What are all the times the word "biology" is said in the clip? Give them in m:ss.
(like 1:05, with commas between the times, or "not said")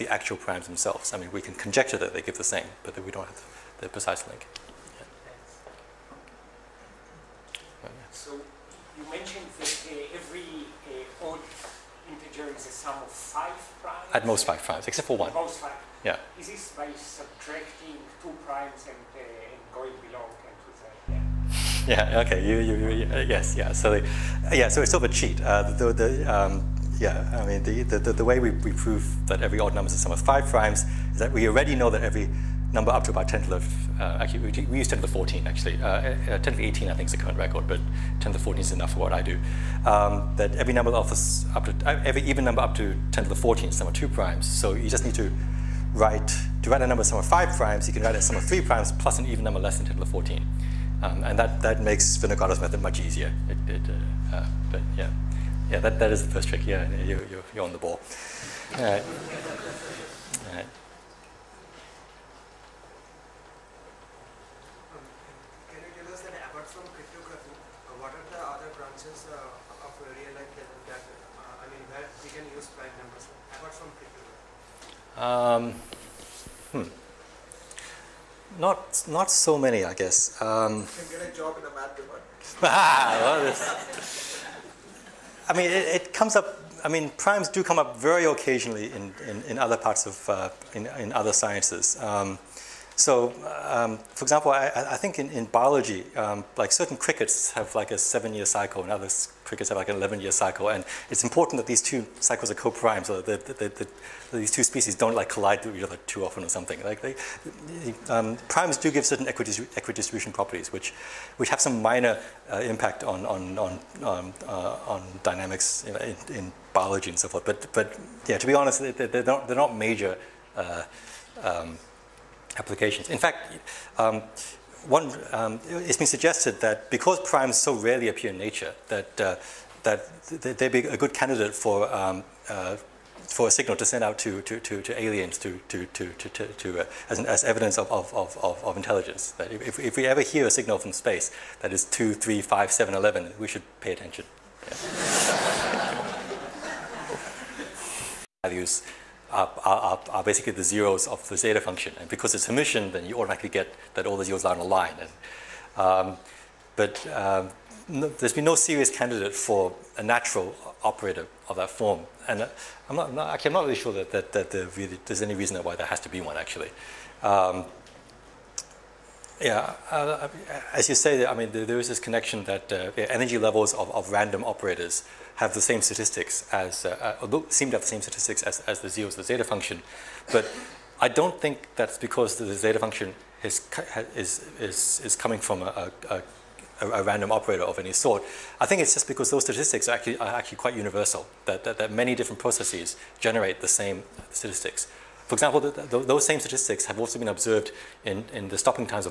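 1:35, 1:56.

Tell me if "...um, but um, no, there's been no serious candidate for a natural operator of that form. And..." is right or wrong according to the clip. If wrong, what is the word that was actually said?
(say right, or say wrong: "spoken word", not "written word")
right.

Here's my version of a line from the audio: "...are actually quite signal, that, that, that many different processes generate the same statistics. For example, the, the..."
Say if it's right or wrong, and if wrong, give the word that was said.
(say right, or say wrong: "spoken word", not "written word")
wrong: "universal", not "signal".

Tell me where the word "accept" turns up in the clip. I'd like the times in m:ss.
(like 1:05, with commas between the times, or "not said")
not said.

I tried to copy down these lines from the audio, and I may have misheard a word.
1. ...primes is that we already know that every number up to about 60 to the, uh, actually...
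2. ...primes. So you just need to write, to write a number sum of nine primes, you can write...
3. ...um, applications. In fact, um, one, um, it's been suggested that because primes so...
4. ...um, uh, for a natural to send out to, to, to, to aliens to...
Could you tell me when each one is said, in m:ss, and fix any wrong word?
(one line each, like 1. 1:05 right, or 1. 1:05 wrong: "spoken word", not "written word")
1. 0:30 wrong: "10", not "60"
2. 0:44 wrong: "five", not "nine"
3. 2:01 right
4. 2:11 wrong: "signal", not "natural".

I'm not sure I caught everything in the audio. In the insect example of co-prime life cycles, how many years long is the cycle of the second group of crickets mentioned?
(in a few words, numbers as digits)
11.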